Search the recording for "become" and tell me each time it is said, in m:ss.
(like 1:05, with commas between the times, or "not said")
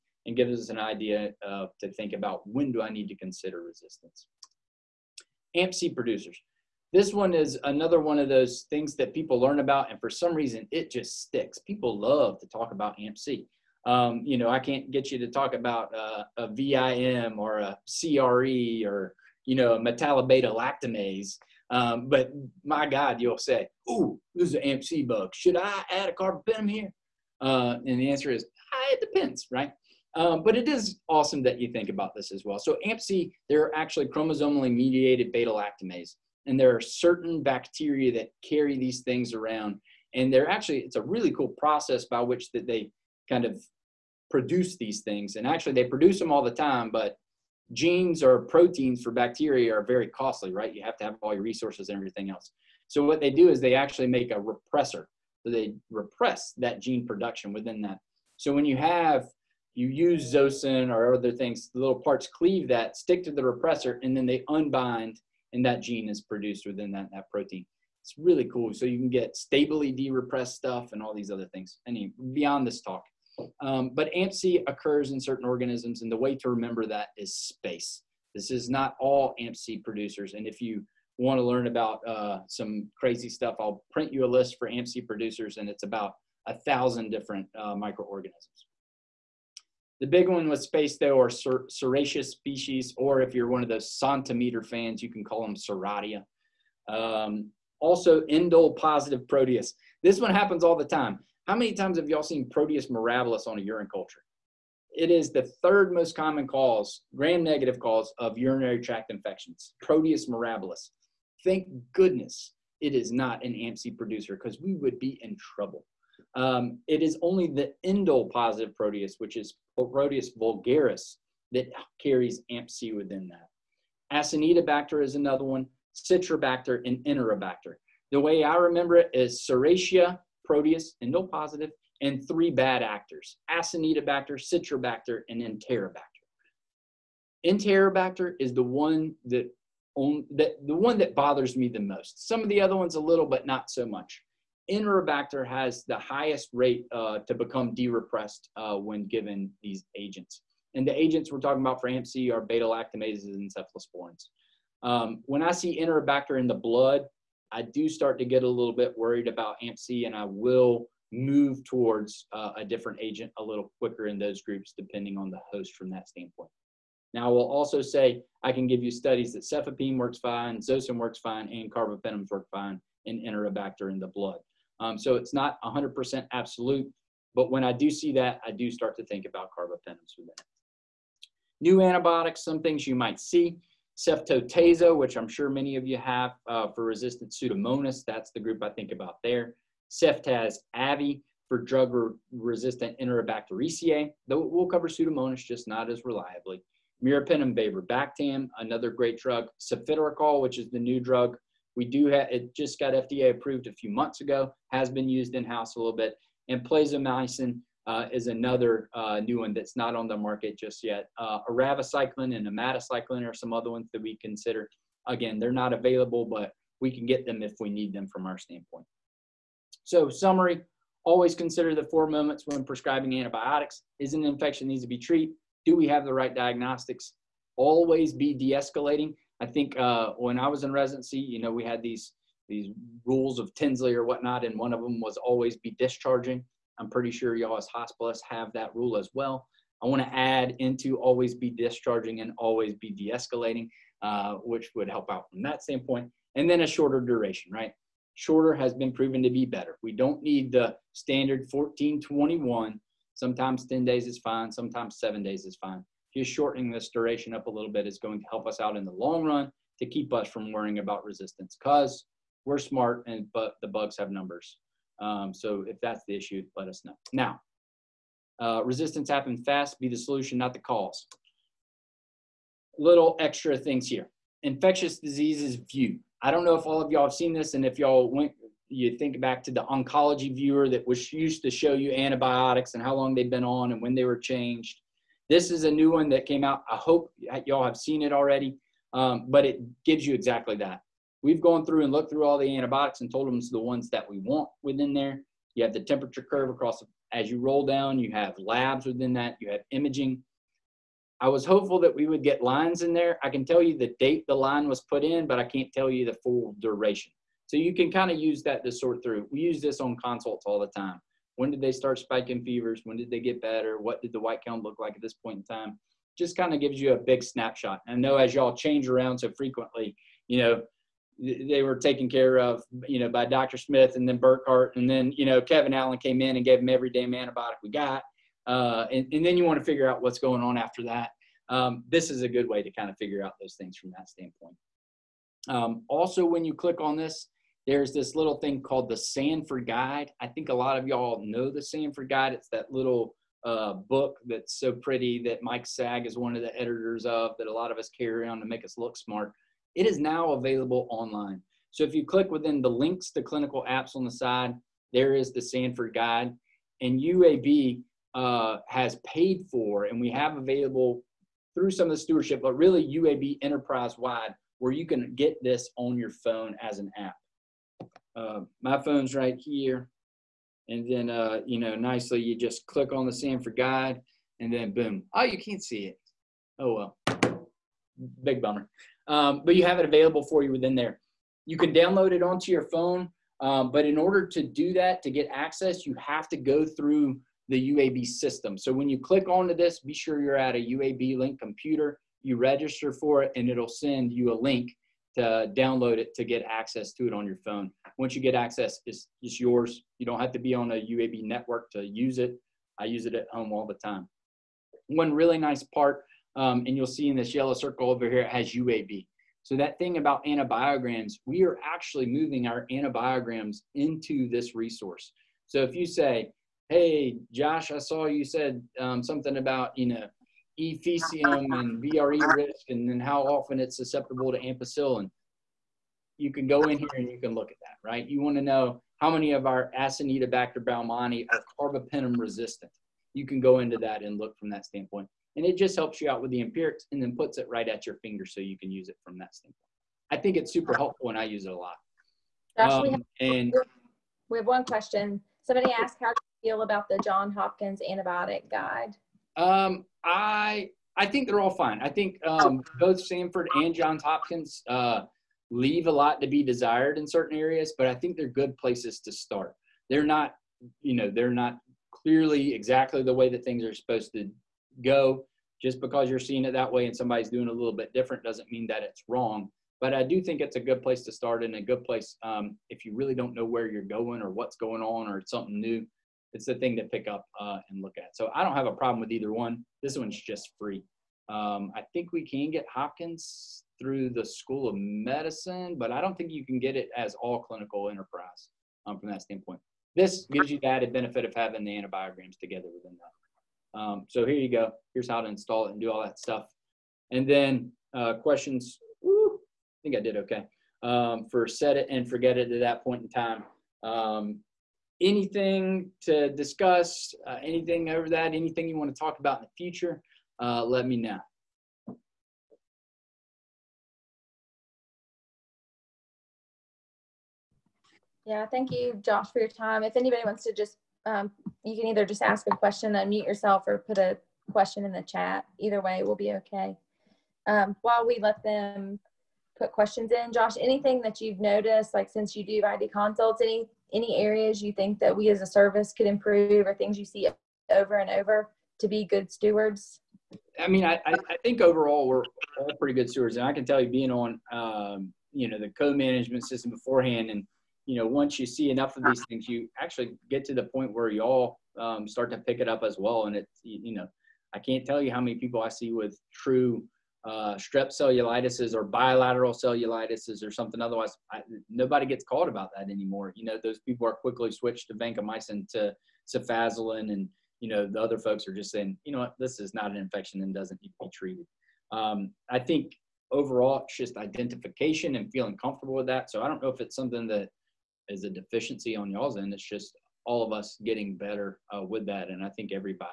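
2:27.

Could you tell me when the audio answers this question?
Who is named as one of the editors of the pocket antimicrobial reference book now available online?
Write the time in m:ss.
5:45.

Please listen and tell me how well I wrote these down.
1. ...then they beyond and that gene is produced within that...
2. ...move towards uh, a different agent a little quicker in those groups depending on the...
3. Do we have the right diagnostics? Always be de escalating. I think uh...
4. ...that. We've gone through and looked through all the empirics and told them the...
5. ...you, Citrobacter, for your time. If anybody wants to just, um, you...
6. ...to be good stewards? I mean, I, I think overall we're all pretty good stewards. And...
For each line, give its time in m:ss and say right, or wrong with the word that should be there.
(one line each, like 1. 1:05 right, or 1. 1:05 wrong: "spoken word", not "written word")
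1. 1:04 wrong: "unbind", not "beyond"
2. 2:41 right
3. 3:45 right
4. 4:50 wrong: "antibiotics", not "empirics"
5. 8:38 wrong: "Josh", not "Citrobacter"
6. 8:58 right.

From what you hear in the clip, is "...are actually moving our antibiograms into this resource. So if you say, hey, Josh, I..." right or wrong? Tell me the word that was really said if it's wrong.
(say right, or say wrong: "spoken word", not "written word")
right.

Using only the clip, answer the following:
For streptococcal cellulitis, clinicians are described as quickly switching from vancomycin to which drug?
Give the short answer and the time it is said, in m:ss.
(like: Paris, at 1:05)
cefazolin, at 9:26.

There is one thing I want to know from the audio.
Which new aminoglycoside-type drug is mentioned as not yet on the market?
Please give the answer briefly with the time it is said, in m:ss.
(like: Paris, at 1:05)
plazomycin, at 3:26.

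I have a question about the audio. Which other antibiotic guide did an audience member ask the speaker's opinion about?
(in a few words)
Johns Hopkins.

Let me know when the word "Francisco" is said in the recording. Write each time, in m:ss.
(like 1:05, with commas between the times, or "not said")
not said.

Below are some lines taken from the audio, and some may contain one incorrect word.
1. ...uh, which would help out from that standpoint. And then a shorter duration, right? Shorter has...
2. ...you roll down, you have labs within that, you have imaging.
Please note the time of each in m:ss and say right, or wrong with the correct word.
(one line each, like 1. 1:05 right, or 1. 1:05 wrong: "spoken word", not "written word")
1. 4:04 right
2. 4:57 right.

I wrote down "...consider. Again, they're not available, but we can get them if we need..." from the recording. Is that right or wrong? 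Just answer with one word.
right.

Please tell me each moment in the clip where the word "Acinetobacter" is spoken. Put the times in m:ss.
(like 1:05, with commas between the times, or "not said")
2:04, 2:13, 7:09.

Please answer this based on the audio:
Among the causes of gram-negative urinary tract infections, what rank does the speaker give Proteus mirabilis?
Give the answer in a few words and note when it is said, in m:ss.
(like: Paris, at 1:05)
third most common, at 1:45.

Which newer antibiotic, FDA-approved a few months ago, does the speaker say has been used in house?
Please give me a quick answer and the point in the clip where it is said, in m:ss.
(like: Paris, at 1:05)
Cefiderocol, at 3:19.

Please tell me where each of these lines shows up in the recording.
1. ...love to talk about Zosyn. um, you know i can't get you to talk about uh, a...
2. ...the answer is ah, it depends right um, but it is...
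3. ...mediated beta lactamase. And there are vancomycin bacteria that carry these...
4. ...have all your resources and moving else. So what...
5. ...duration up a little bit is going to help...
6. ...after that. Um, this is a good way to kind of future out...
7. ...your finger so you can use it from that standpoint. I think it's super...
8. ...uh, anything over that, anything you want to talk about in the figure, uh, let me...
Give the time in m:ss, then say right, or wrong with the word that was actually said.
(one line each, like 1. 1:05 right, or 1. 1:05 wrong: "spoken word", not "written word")
1. 0:11 wrong: "AmpC", not "Zosyn"
2. 0:27 right
3. 0:34 wrong: "certain", not "vancomycin"
4. 0:51 wrong: "everything", not "moving"
5. 4:16 right
6. 5:30 wrong: "figure", not "future"
7. 7:17 right
8. 8:27 wrong: "future", not "figure".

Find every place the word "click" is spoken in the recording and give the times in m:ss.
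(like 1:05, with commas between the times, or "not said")
5:36, 5:52, 6:12, 6:28.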